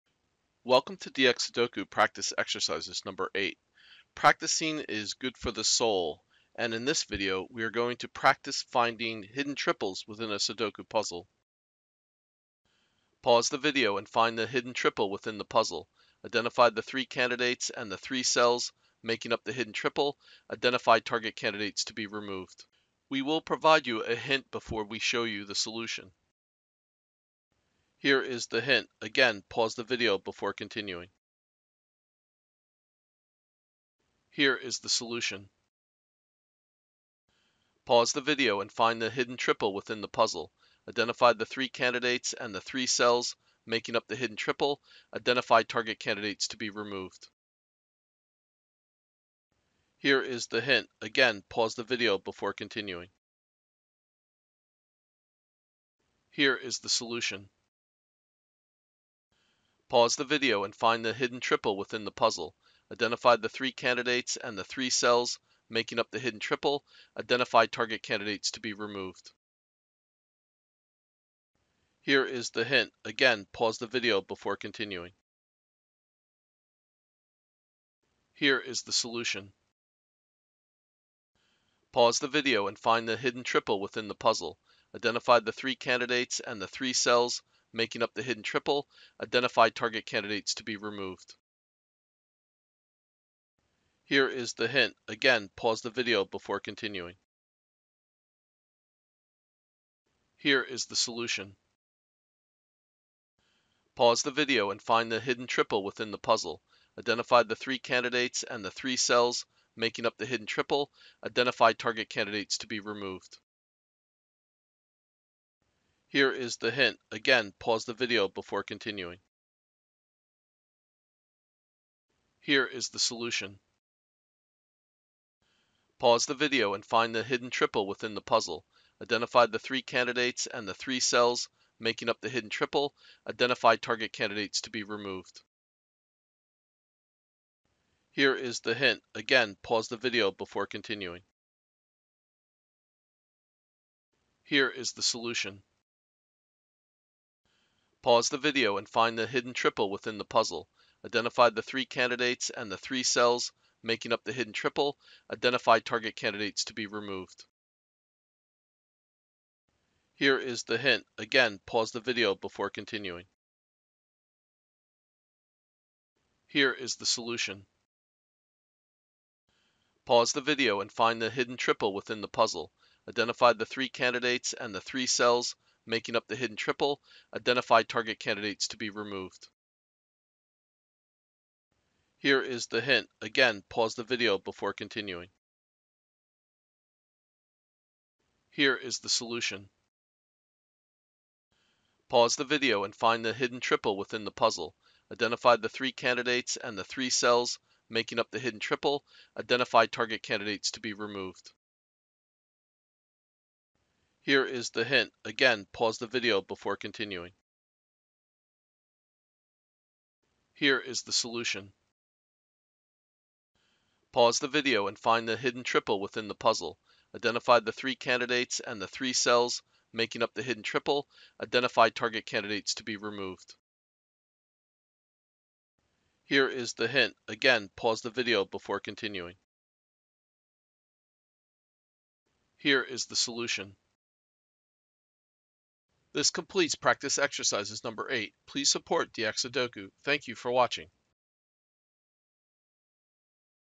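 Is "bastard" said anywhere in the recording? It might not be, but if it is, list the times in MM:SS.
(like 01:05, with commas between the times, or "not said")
not said.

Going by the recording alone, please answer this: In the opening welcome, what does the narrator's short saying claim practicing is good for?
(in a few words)
the soul.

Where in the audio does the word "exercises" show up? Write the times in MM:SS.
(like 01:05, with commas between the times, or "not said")
00:02, 03:57.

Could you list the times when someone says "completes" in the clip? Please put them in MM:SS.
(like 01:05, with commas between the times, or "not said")
03:56.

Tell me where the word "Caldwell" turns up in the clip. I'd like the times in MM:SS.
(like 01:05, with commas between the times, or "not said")
not said.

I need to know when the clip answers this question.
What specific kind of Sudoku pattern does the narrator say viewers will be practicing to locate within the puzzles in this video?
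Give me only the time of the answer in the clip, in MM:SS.
00:09.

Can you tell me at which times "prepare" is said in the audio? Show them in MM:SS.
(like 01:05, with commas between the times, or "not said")
not said.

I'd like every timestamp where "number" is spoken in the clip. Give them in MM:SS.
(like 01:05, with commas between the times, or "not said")
00:03, 03:57.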